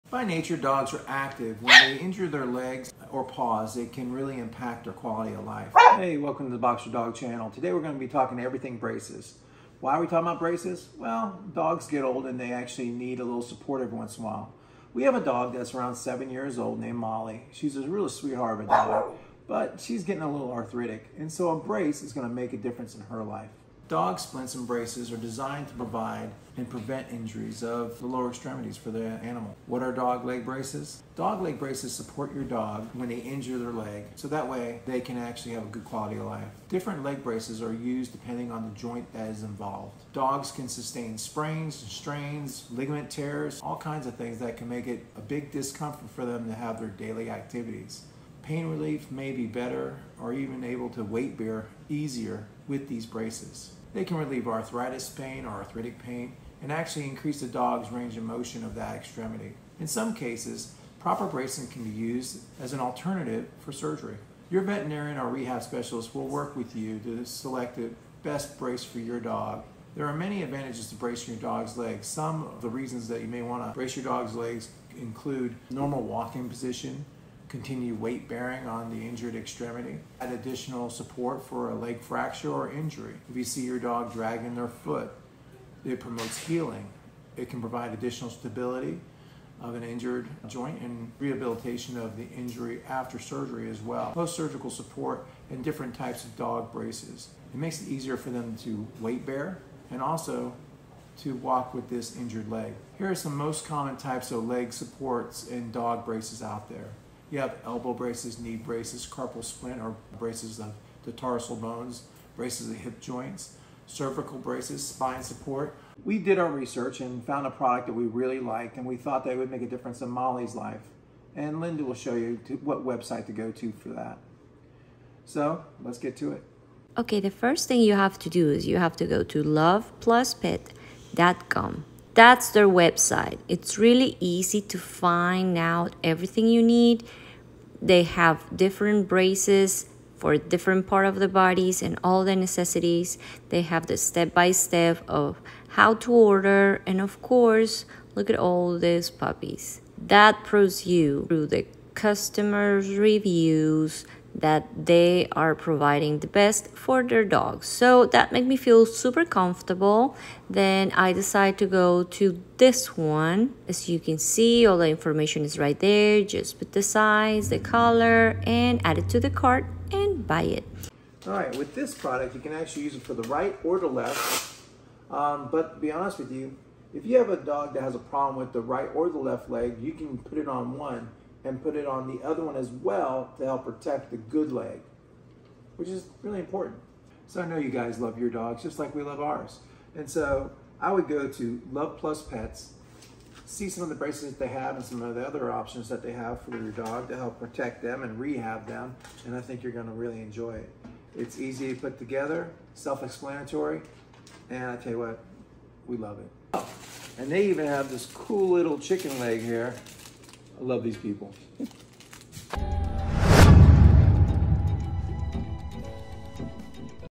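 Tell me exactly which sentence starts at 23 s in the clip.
Dog splints and braces are designed to provide and prevent injuries of the lower extremities for the animal.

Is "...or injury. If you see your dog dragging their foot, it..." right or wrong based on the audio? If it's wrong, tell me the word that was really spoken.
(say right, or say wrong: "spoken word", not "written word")
right.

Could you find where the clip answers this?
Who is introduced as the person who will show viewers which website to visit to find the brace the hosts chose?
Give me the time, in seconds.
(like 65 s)
121 s.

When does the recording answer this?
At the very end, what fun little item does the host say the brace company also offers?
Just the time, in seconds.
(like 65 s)
208 s.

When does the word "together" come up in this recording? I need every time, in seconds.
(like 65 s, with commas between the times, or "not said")
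201 s.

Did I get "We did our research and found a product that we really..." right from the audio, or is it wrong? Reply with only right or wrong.
right.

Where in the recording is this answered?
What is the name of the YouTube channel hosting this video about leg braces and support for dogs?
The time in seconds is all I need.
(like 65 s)
6 s.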